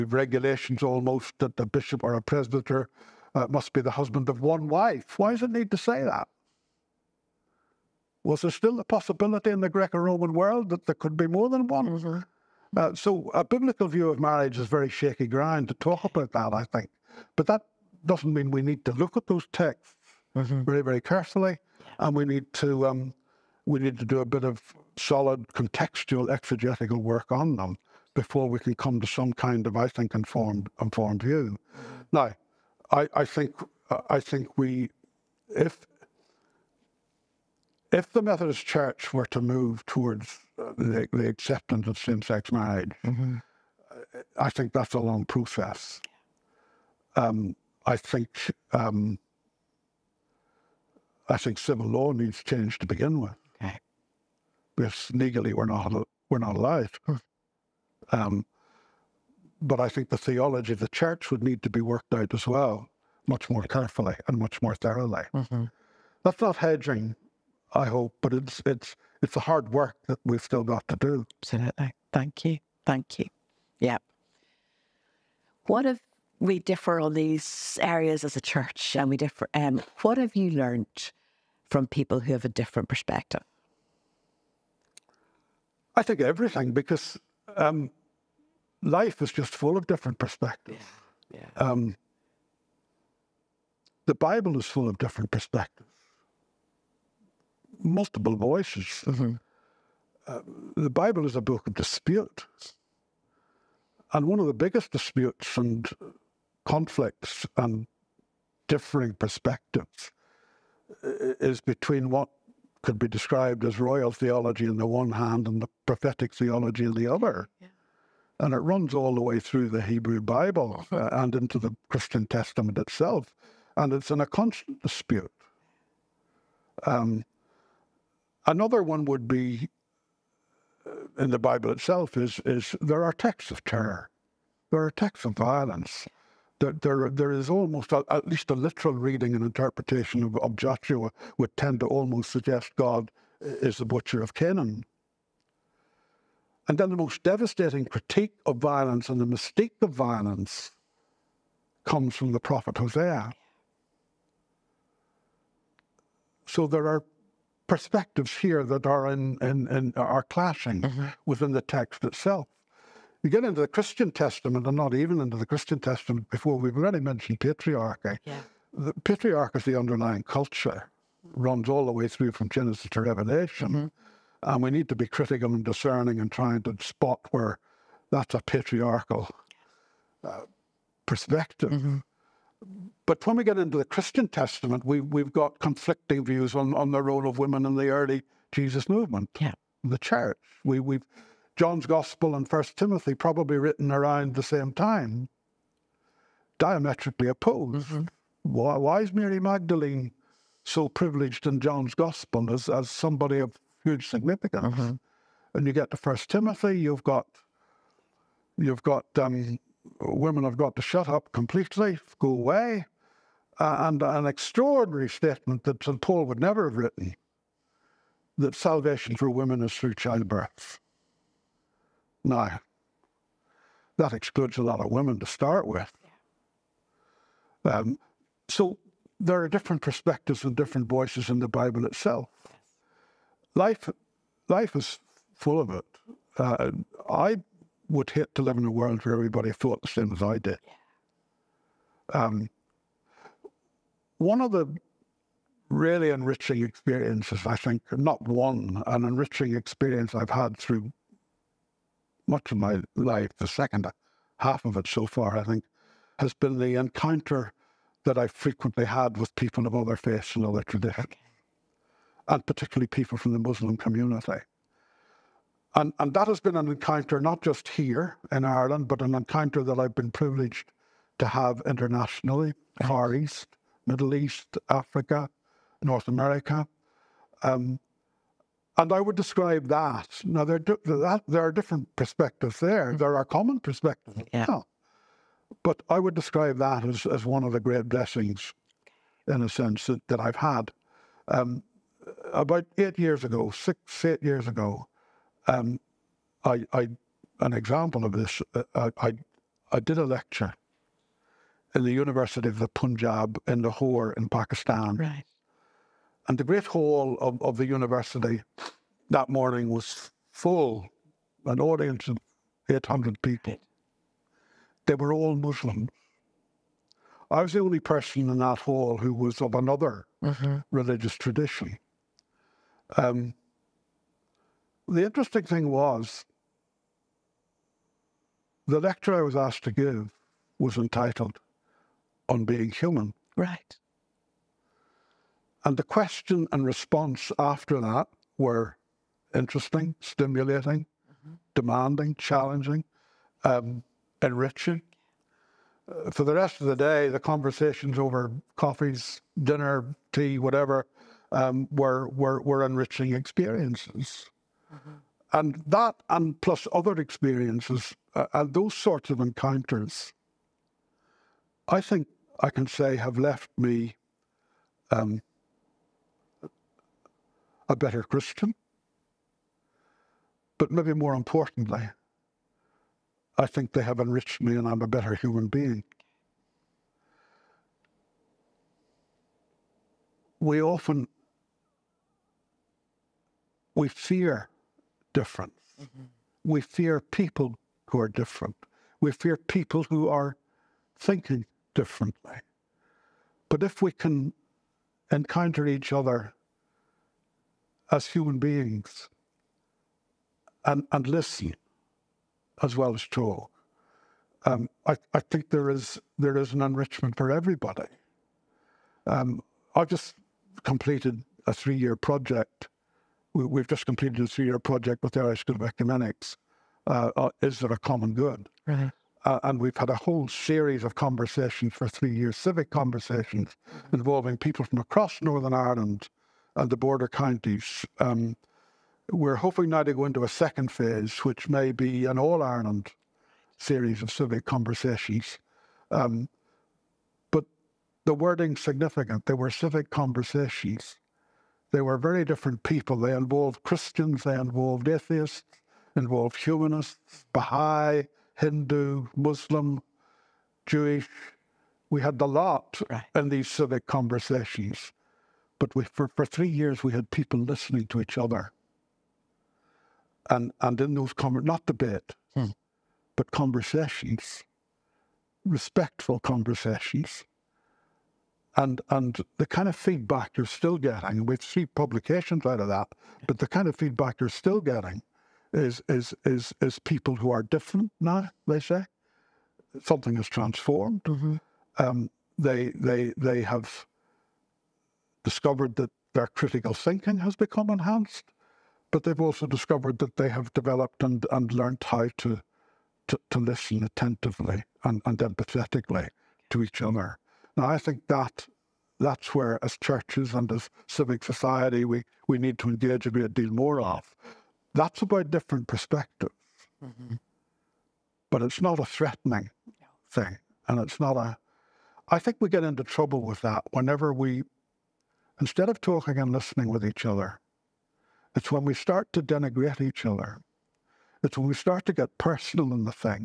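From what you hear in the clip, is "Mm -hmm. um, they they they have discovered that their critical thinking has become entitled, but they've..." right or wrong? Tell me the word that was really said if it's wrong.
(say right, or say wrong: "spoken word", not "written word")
wrong: "enhanced", not "entitled".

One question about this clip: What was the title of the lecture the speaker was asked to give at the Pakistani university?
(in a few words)
On Being Human.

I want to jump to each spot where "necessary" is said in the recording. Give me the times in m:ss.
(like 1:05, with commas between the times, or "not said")
not said.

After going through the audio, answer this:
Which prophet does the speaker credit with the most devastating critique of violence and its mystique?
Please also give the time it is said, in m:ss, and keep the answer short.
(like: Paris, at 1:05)
Hosea, at 2:32.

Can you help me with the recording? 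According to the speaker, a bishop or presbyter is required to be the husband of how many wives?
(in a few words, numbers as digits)
1.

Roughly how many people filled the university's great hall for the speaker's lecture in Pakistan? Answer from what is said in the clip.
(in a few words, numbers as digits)
800.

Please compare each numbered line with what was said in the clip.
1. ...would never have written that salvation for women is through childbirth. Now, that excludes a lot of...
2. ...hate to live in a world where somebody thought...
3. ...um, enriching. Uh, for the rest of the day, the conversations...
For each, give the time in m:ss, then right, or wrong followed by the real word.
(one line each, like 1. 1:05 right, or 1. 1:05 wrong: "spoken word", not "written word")
1. 3:36 right
2. 3:58 wrong: "everybody", not "somebody"
3. 5:43 right.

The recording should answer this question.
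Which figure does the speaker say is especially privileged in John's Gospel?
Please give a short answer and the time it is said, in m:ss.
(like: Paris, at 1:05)
Mary Magdalene, at 3:19.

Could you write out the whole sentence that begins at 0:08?
Was there still a possibility in the Greco-Roman world that there could be more than one?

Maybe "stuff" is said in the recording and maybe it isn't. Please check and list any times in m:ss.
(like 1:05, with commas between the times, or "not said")
not said.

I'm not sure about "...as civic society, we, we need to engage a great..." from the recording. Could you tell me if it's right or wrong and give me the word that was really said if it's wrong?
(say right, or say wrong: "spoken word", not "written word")
right.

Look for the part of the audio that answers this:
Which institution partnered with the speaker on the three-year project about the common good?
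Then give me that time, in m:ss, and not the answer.
6:55.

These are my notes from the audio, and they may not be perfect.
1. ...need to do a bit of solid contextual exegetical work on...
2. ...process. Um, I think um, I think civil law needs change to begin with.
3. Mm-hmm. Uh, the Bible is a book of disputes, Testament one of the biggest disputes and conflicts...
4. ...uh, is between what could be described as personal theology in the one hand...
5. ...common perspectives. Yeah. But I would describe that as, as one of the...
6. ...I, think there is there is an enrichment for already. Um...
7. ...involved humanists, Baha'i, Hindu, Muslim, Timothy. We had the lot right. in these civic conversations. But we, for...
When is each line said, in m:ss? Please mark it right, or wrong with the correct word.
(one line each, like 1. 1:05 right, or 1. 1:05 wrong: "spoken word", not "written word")
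1. 0:23 right
2. 0:45 right
3. 1:39 wrong: "And", not "Testament"
4. 1:51 wrong: "royal", not "personal"
5. 4:43 right
6. 6:45 wrong: "everybody", not "already"
7. 7:25 wrong: "Jewish", not "Timothy".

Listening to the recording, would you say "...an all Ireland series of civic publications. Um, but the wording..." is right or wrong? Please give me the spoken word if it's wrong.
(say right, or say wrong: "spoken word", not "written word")
wrong: "conversations", not "publications".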